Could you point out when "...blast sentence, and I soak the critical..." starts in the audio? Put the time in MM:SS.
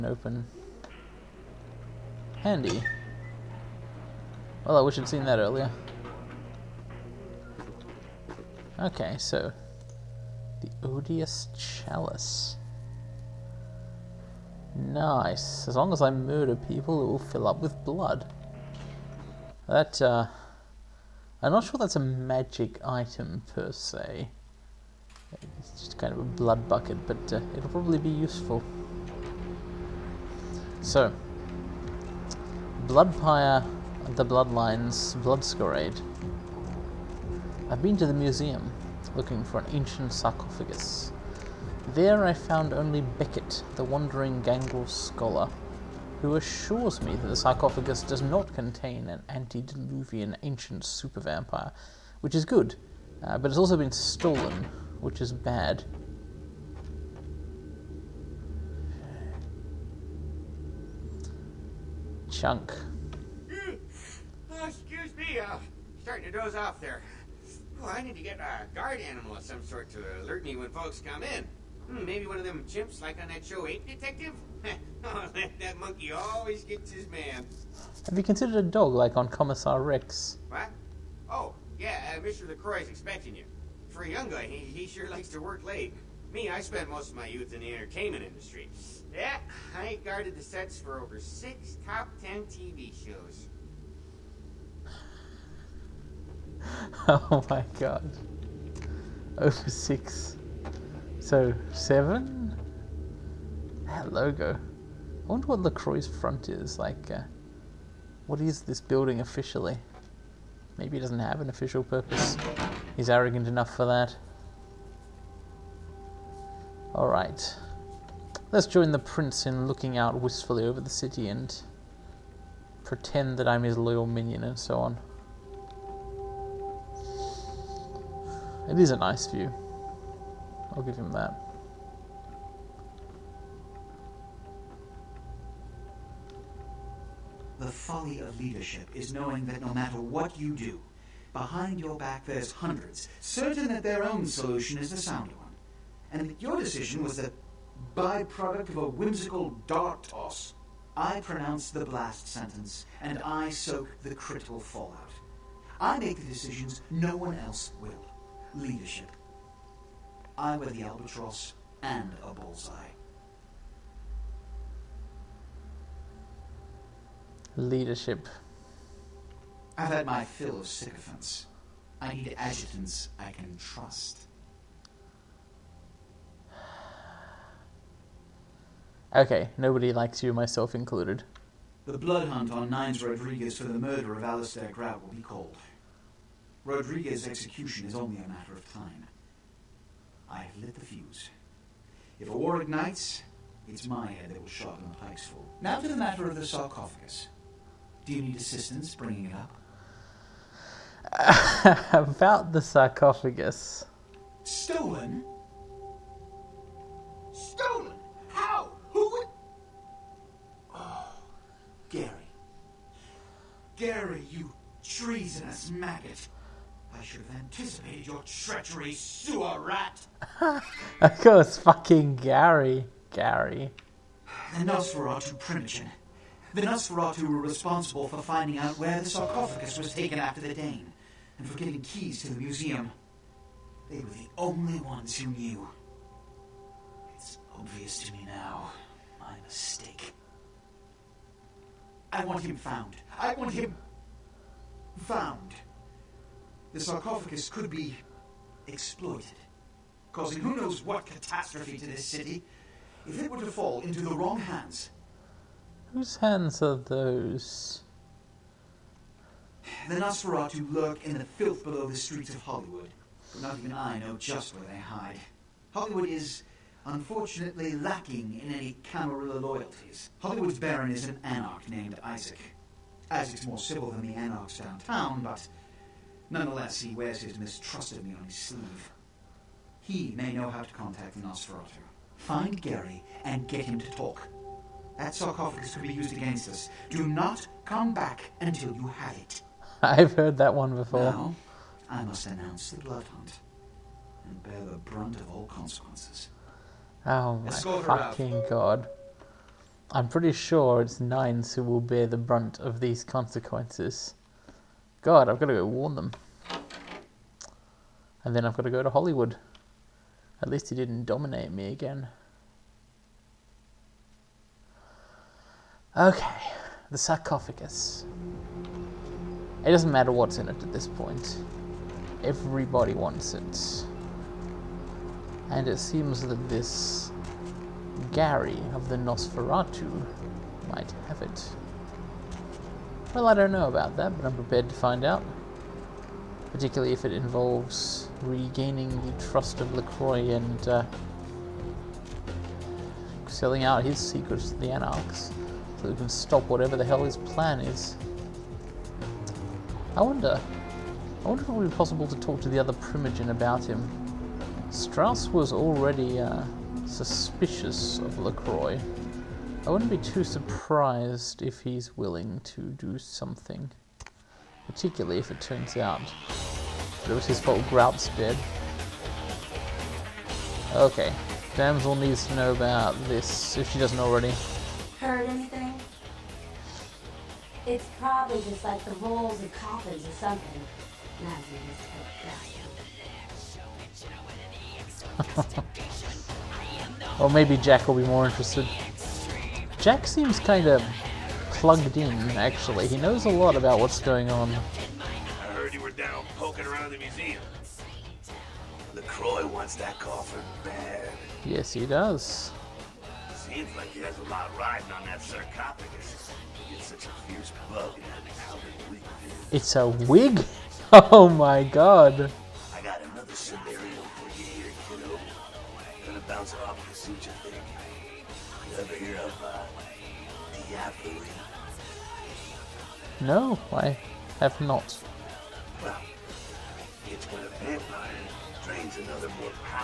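02:31.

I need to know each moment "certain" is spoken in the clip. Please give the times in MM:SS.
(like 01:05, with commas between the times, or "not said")
02:23.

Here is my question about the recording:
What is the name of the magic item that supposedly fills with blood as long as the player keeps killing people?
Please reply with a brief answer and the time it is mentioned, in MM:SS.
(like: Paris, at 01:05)
Odious Chalice, at 00:10.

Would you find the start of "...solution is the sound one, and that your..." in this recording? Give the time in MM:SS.
02:24.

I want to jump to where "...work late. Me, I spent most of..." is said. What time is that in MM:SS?
01:25.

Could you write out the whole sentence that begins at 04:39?
He may know how to contact Nosferatu.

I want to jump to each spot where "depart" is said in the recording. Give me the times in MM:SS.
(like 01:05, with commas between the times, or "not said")
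not said.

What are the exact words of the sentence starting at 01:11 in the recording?
Hmm, maybe one of them chimps like on that show Ape eh, Detective?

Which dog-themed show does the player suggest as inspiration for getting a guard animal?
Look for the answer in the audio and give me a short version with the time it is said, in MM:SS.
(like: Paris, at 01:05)
Commissar Rex, at 01:19.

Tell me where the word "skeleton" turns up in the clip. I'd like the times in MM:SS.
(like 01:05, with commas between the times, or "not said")
not said.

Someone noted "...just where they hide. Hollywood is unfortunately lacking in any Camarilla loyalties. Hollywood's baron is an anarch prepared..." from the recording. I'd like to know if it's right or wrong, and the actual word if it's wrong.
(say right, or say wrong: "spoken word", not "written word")
wrong: "named", not "prepared".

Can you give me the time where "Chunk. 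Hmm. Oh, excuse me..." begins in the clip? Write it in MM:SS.
01:02.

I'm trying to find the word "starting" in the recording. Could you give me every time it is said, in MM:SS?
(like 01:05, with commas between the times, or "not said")
01:06.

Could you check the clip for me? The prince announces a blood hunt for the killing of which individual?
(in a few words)
Alistair Grout.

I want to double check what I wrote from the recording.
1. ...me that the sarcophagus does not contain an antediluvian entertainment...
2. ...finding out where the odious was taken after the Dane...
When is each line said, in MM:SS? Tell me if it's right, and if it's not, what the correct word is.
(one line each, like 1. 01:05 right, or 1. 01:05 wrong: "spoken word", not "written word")
1. 00:47 wrong: "ancient", not "entertainment"
2. 03:48 wrong: "sarcophagus", not "odious".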